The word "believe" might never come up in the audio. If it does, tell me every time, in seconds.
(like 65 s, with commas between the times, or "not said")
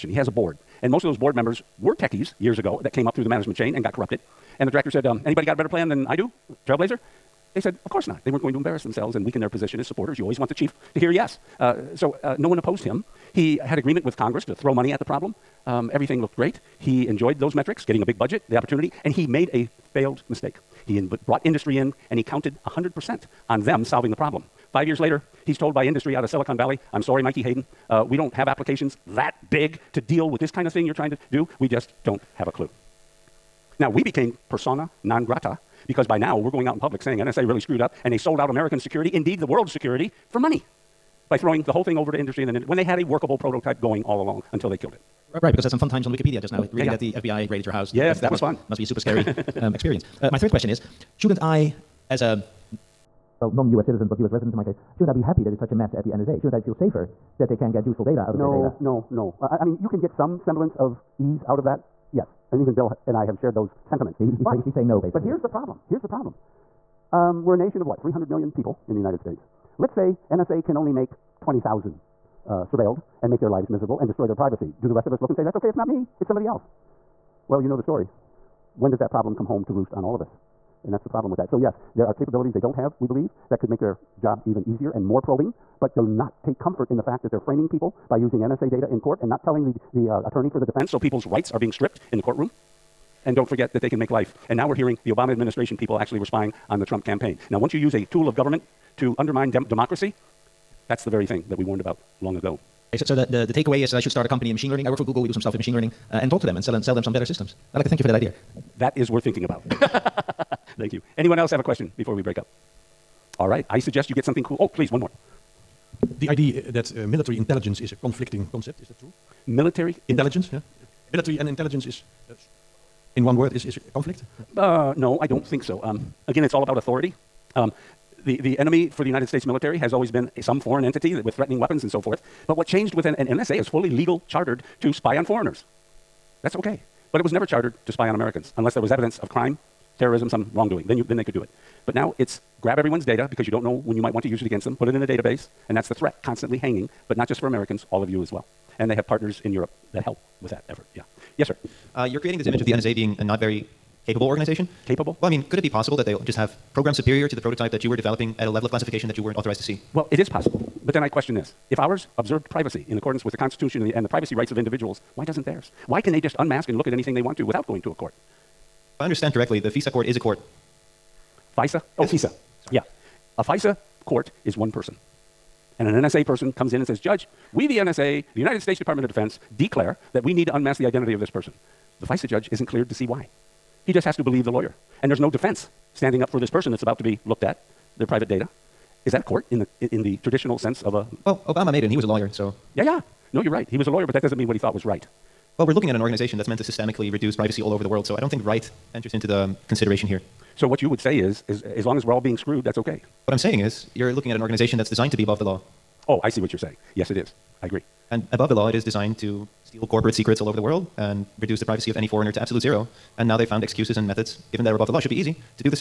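83 s, 184 s.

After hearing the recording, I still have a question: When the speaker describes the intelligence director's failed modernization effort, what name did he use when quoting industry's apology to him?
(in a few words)
Mikey Hayden.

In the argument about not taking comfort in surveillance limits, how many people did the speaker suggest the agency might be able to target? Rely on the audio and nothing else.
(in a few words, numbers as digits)
20,000.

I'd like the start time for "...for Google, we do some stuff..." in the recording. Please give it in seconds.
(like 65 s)
104 s.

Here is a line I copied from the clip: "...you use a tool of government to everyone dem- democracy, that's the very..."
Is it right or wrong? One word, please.
wrong.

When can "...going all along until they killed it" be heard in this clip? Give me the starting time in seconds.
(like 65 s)
43 s.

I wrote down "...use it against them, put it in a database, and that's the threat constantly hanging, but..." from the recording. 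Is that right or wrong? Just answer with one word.
right.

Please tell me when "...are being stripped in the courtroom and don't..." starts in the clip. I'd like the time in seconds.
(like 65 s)
91 s.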